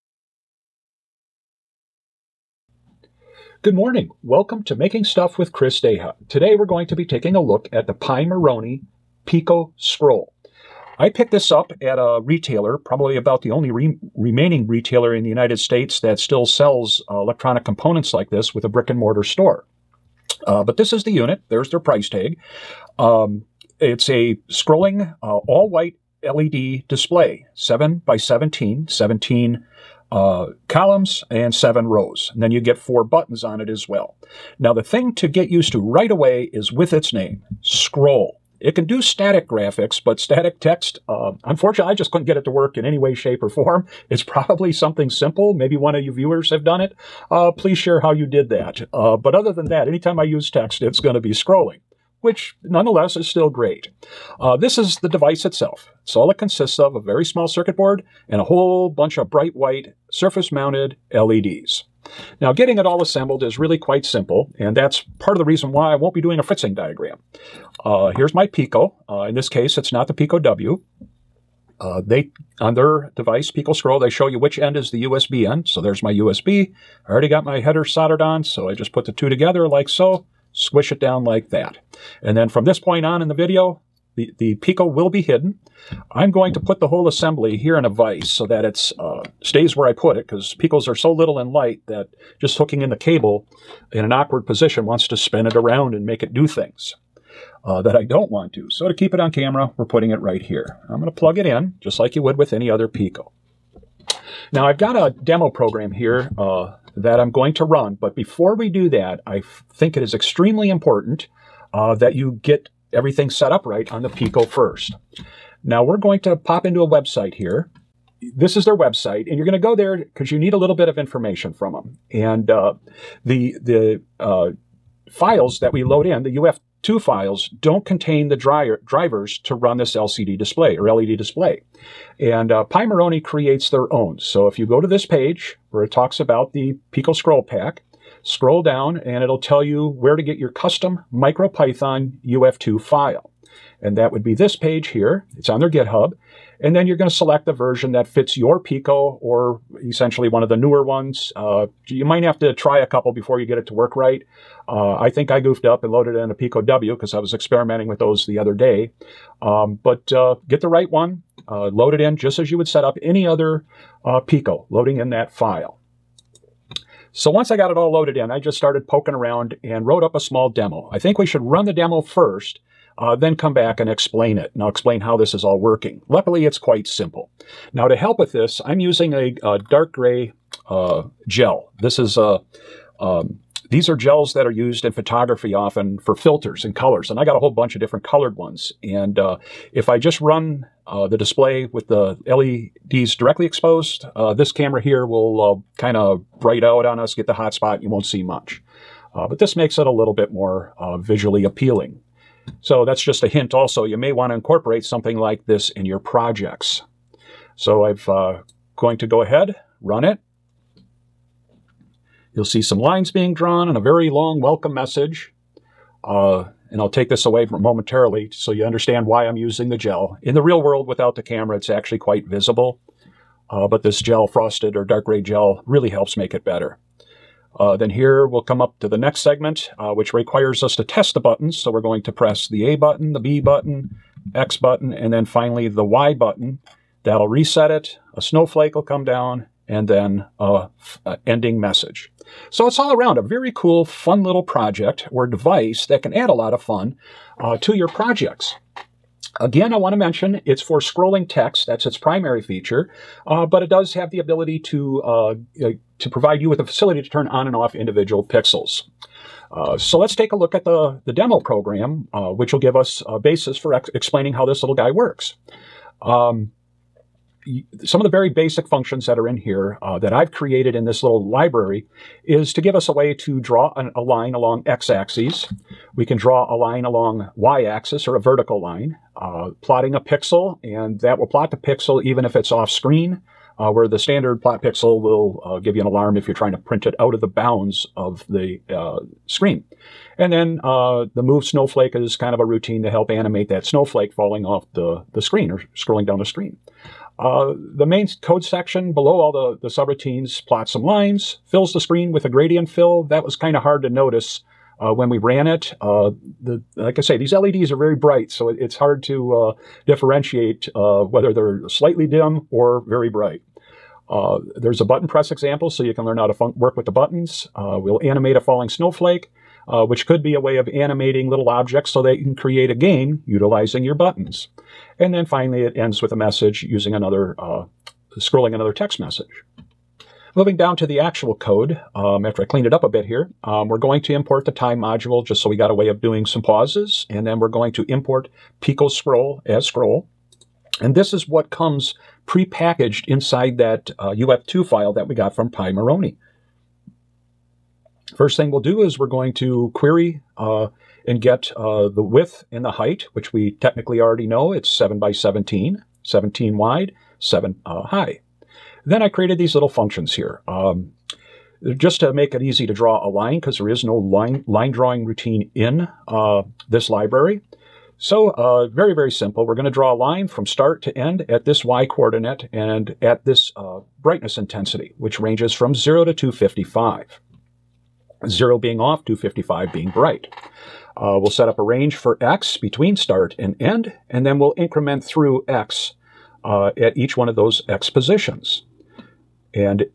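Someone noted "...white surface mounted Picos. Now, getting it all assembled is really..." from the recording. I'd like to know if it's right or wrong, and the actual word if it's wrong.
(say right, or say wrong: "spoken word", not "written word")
wrong: "LEDs", not "Picos".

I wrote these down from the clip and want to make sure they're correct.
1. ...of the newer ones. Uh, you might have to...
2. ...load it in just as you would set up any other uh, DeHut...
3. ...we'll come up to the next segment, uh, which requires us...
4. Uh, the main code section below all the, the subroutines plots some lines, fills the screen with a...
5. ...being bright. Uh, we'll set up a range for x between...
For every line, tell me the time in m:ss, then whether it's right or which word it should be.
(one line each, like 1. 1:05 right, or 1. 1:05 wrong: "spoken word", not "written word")
1. 2:30 right
2. 2:41 wrong: "Pico", not "DeHut"
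3. 3:48 right
4. 4:57 right
5. 6:19 right.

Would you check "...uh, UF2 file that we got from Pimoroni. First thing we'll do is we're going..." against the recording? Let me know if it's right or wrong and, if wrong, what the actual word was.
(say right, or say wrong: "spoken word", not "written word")
right.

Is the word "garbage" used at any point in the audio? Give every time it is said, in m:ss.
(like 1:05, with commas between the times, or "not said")
not said.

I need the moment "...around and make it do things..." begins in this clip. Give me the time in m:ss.
1:35.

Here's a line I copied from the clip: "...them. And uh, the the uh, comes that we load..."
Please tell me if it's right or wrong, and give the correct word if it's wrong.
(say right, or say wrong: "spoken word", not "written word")
wrong: "files", not "comes".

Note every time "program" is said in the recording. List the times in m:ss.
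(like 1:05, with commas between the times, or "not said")
1:45, 4:21.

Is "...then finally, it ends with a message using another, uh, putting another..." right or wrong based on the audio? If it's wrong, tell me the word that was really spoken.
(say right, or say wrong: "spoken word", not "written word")
wrong: "scrolling", not "putting".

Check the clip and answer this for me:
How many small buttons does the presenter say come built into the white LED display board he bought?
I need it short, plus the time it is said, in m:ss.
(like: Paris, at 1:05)
4, at 0:32.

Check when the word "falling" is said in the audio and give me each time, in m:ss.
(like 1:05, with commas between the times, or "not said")
4:54, 5:18.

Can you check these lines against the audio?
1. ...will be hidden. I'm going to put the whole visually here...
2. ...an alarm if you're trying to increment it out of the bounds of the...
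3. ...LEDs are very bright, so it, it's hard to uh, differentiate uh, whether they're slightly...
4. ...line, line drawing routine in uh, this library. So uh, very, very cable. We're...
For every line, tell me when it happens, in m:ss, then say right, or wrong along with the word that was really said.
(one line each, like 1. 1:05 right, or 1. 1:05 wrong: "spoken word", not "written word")
1. 1:24 wrong: "assembly", not "visually"
2. 4:45 wrong: "print", not "increment"
3. 5:07 right
4. 6:03 wrong: "simple", not "cable".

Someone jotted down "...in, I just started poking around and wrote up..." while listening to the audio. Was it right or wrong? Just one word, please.
right.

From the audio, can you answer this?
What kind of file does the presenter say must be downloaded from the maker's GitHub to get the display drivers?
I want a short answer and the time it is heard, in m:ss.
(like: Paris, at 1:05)
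UF2 file, at 2:21.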